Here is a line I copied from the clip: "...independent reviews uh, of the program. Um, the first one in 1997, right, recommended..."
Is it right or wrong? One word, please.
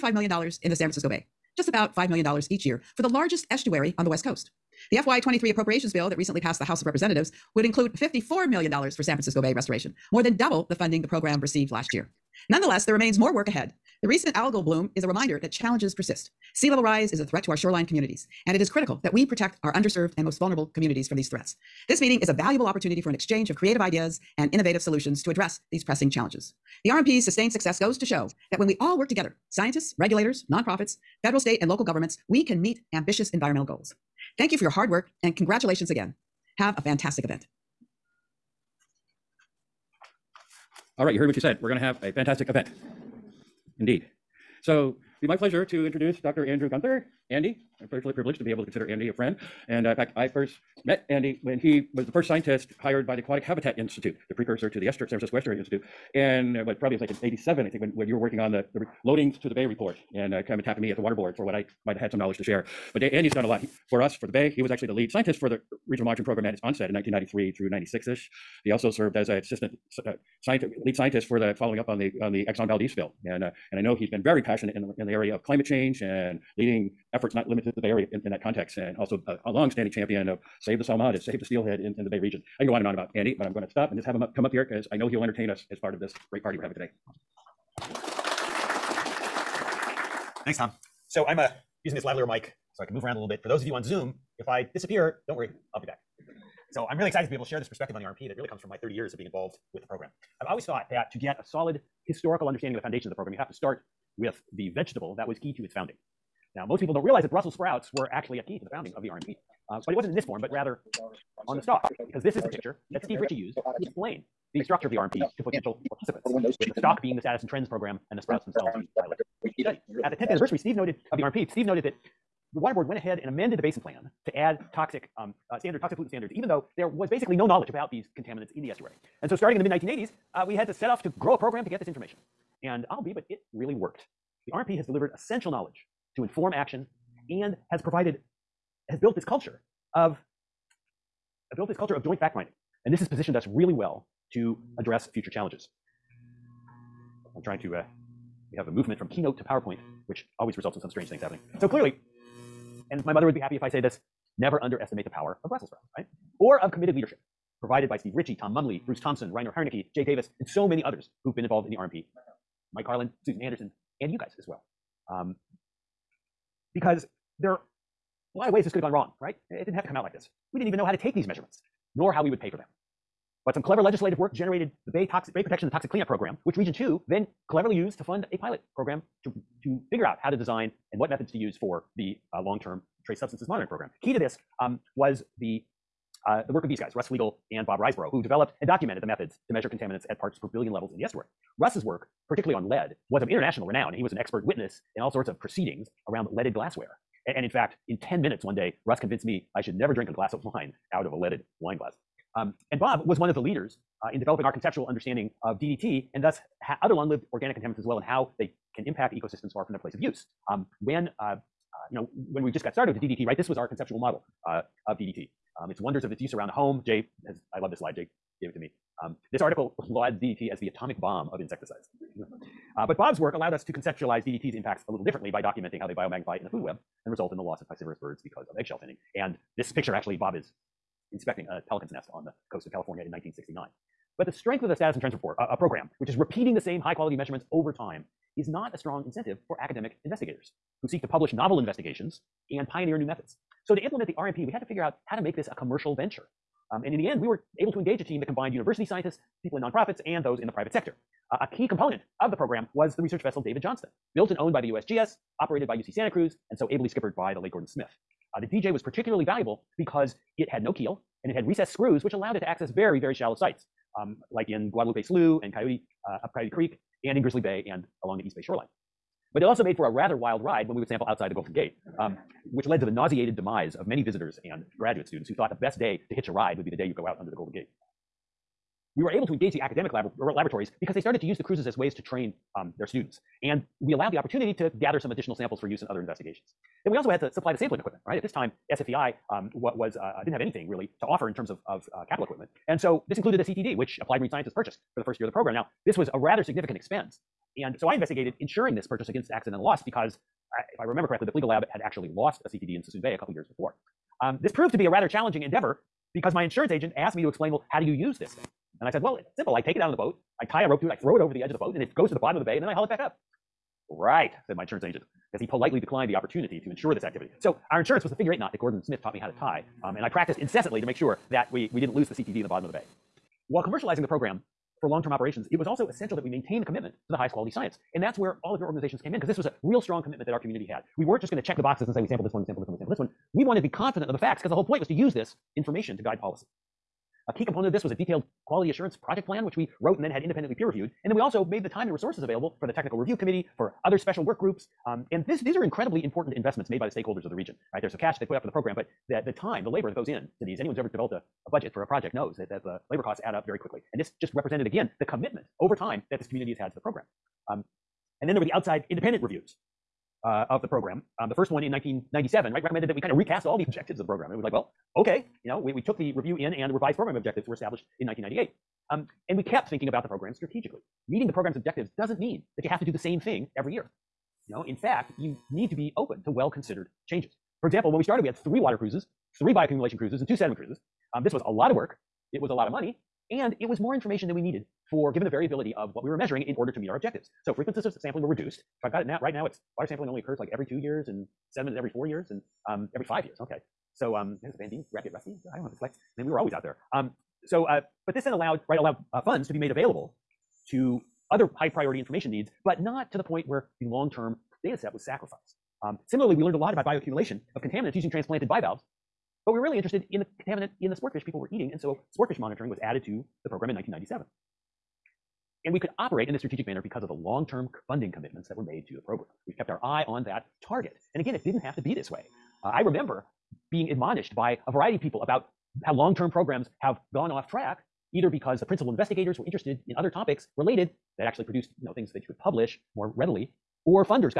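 right.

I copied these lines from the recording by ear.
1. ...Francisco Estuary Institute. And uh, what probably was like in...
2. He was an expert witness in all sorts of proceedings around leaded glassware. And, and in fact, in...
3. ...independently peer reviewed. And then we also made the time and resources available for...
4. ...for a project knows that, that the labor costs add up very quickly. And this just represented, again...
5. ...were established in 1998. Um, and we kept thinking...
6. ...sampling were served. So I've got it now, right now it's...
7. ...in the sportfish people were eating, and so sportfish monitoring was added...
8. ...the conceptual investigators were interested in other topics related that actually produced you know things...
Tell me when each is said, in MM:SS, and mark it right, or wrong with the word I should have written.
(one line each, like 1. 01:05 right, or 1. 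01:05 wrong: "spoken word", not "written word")
1. 00:55 right
2. 03:13 right
3. 05:40 right
4. 05:51 right
5. 06:07 right
6. 06:27 wrong: "reduced", not "served"
7. 06:50 right
8. 07:08 wrong: "principal", not "conceptual".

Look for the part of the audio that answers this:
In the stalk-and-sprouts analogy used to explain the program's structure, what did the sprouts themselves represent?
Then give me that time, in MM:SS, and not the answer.
01:58.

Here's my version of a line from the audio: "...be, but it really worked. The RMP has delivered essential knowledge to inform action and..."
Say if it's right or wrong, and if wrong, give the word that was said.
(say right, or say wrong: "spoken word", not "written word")
right.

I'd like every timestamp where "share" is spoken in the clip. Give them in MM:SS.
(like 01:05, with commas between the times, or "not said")
01:02, 01:37.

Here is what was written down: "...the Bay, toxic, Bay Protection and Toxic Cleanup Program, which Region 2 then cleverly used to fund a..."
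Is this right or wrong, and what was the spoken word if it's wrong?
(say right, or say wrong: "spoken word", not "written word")
right.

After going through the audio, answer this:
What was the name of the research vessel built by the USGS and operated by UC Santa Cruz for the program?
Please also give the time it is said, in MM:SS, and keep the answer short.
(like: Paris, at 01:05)
David Johnston, at 04:13.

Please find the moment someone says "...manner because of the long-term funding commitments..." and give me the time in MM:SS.
06:56.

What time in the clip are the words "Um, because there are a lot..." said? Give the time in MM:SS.
02:45.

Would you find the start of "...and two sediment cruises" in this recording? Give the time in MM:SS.
06:20.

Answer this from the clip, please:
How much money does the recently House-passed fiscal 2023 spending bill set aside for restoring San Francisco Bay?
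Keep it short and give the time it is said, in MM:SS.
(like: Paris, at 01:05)
$54 million, at 00:07.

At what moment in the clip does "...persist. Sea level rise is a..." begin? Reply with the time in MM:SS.
00:15.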